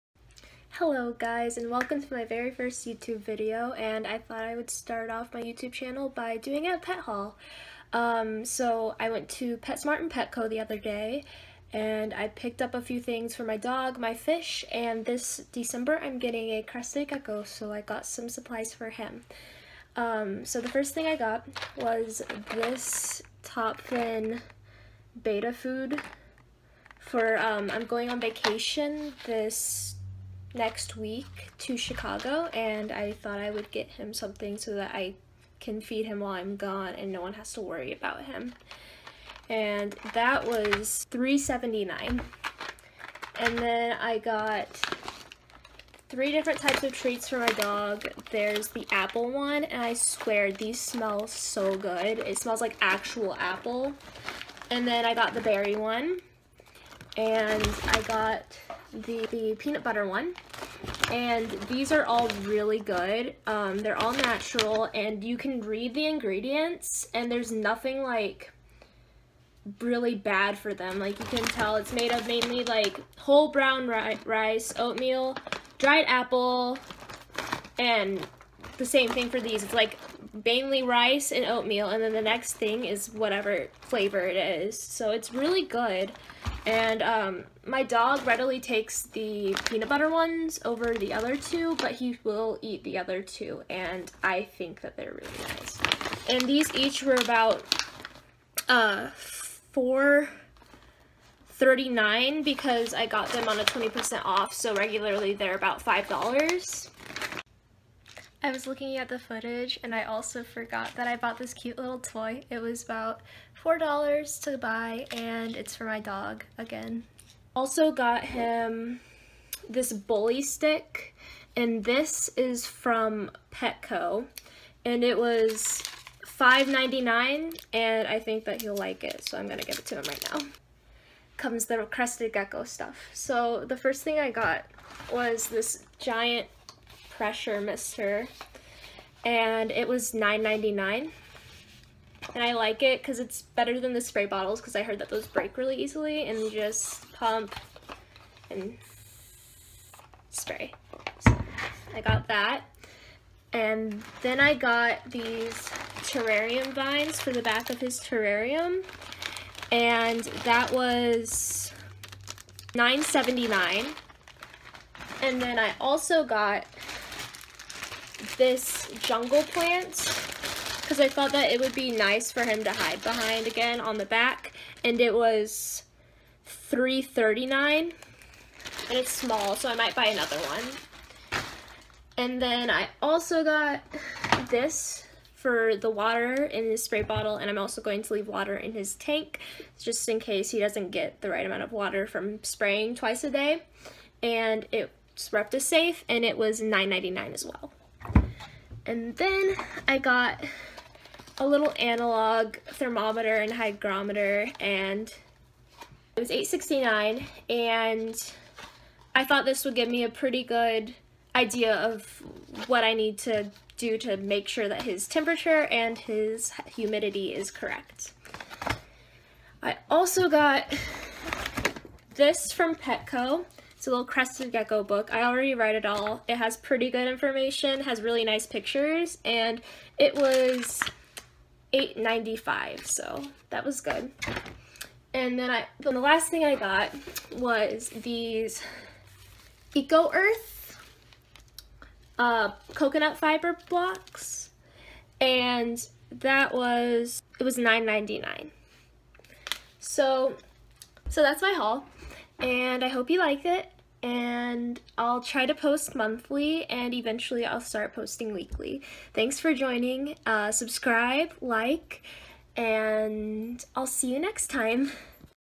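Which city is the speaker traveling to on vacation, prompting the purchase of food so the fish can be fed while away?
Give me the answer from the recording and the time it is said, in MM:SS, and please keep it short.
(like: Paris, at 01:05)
Chicago, at 00:31.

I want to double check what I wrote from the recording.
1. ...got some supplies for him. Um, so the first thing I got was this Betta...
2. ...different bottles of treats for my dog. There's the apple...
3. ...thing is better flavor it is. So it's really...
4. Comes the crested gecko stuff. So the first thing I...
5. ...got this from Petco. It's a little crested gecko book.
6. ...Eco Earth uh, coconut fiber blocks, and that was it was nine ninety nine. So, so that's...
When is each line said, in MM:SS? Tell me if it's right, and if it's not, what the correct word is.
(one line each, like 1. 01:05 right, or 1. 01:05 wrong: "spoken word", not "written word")
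1. 00:17 wrong: "Top", not "Betta"
2. 00:46 wrong: "types", not "bottles"
3. 01:22 wrong: "whatever", not "better"
4. 02:11 right
5. 03:40 right
6. 03:59 right.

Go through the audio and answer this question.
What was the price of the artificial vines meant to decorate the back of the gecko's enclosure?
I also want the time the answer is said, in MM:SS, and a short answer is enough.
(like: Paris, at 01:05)
$9.79, at 02:42.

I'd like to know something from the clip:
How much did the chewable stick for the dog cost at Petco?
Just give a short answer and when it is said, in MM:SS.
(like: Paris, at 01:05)
$5.99, at 02:06.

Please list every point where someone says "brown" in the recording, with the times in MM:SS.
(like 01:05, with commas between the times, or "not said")
01:13.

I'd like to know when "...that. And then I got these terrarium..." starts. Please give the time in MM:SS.
02:32.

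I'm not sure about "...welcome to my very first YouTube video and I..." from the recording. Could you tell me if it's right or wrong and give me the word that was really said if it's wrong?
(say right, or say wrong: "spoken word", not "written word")
right.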